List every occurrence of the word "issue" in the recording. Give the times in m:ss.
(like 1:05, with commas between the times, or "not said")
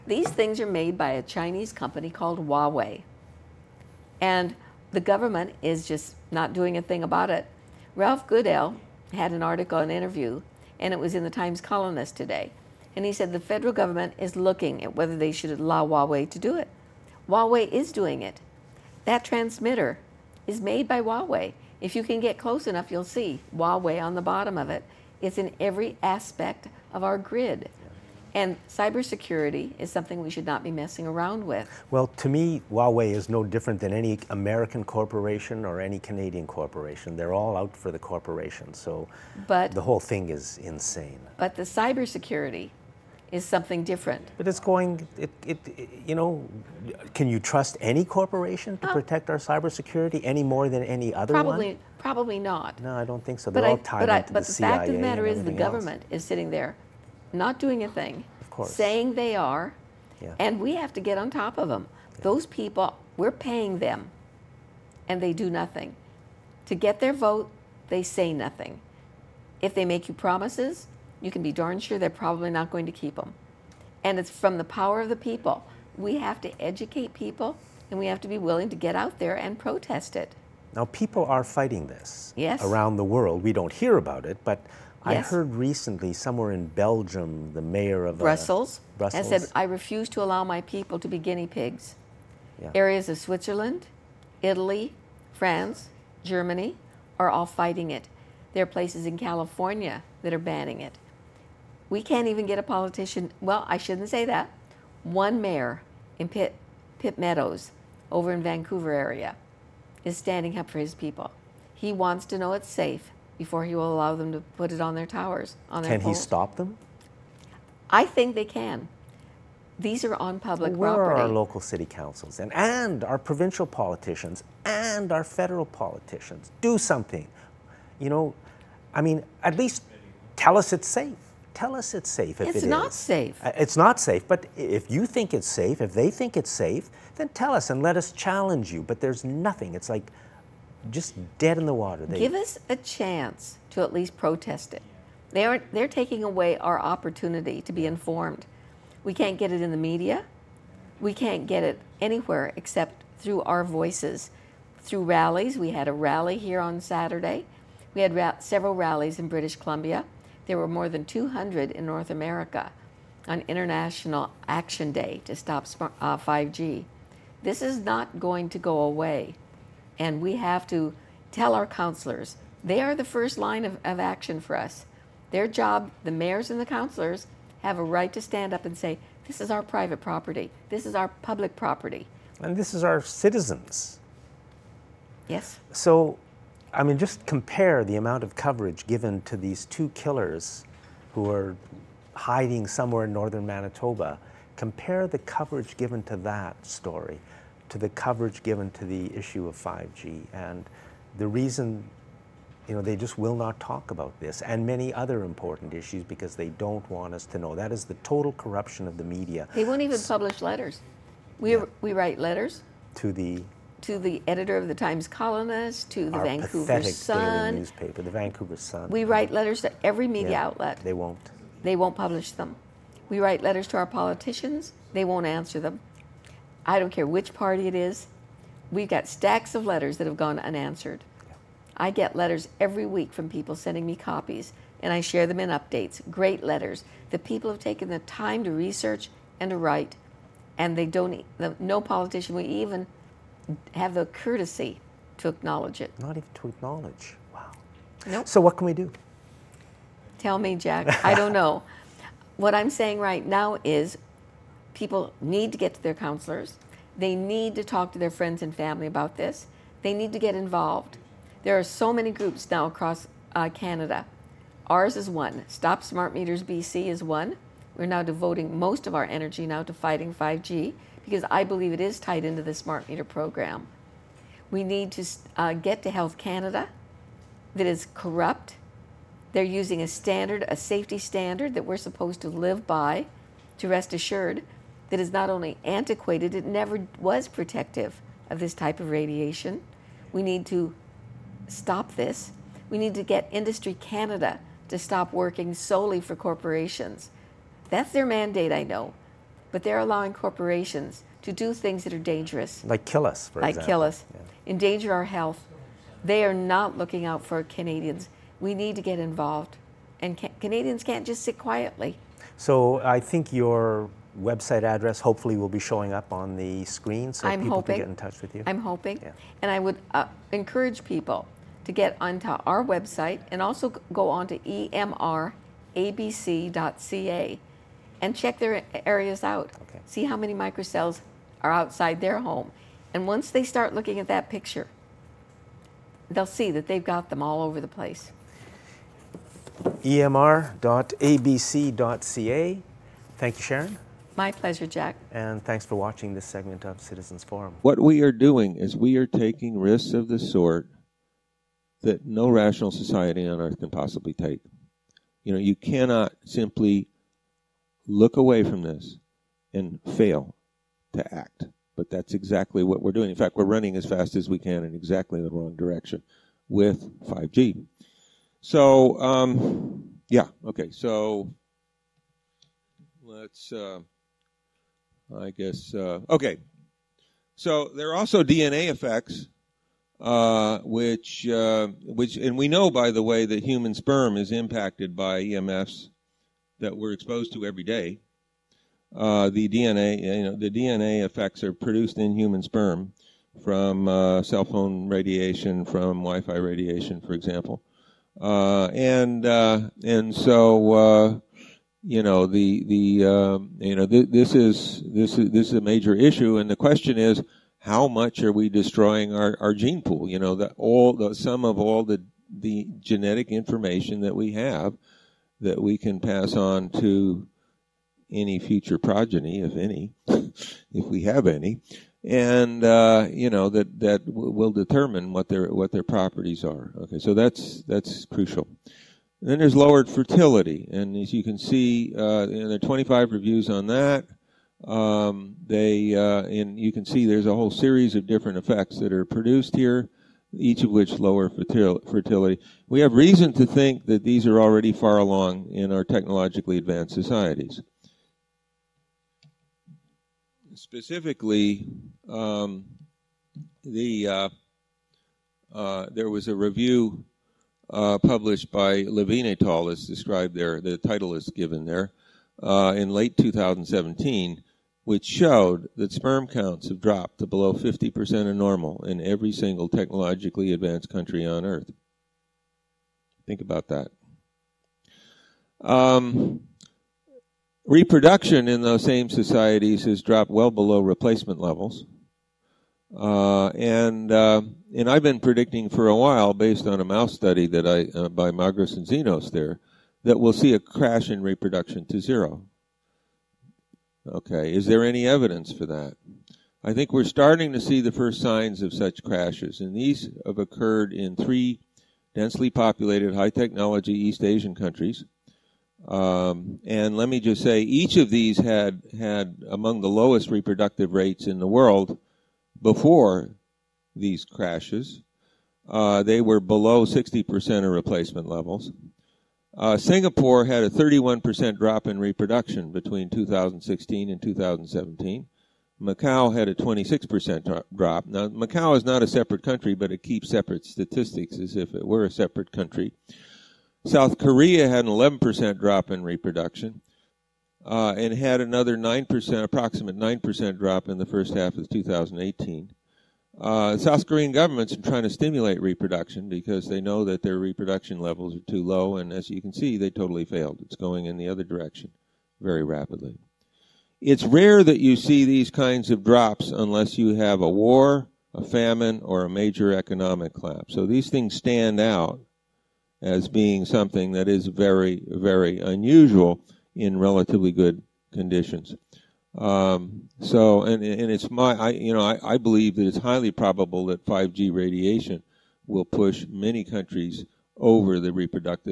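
3:19, 3:25, 6:45.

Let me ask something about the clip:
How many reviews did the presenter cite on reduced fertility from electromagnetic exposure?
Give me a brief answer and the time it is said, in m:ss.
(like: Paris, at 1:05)
25, at 7:12.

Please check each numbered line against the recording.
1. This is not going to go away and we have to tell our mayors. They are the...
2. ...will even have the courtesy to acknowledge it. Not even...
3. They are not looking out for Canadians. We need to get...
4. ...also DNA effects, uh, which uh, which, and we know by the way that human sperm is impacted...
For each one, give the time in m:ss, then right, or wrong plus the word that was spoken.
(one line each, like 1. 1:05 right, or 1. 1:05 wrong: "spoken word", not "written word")
1. 2:47 wrong: "counselors", not "mayors"
2. 4:02 right
3. 5:06 right
4. 6:17 right.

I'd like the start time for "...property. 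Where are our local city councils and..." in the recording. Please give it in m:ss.
2:00.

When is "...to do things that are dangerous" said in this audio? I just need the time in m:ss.
5:01.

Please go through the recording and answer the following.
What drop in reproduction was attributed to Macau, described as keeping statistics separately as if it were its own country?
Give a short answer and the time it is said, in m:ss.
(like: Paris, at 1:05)
26%, at 8:46.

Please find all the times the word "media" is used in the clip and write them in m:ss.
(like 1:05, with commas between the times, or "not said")
2:29, 3:29, 3:40.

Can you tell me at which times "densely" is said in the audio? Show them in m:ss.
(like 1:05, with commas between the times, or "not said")
8:22.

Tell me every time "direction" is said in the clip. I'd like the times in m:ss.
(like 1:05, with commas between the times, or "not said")
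6:05, 9:11.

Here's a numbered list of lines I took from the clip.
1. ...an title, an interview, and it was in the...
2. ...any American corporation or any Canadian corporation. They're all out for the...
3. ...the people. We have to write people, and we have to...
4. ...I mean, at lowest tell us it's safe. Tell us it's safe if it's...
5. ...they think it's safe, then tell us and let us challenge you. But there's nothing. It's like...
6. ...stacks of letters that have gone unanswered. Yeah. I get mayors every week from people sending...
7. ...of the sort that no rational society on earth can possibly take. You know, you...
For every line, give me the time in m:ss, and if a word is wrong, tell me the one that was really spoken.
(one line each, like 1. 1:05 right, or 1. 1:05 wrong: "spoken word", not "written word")
1. 0:09 wrong: "article", not "title"
2. 0:33 right
3. 1:15 wrong: "educate", not "write"
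4. 2:08 wrong: "least", not "lowest"
5. 2:15 right
6. 3:49 wrong: "letters", not "mayors"
7. 5:49 right.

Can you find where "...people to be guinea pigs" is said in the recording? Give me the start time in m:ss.
1:30.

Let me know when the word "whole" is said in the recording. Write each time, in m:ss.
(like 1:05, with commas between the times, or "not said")
0:39, 7:17.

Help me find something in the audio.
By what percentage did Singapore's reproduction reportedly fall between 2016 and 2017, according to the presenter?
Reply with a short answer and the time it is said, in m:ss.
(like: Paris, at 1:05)
31%, at 8:40.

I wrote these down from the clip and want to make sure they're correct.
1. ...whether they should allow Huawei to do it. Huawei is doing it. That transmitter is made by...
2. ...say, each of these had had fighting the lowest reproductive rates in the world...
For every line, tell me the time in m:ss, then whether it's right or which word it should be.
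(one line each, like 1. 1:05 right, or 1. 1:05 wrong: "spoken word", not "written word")
1. 0:14 right
2. 8:27 wrong: "among", not "fighting".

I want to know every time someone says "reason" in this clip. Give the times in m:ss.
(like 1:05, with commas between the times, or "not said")
3:21, 7:22.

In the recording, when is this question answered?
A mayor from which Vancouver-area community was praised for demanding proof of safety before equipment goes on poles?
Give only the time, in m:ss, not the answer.
1:46.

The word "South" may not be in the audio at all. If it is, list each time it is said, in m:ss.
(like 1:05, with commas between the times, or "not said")
8:53, 9:03.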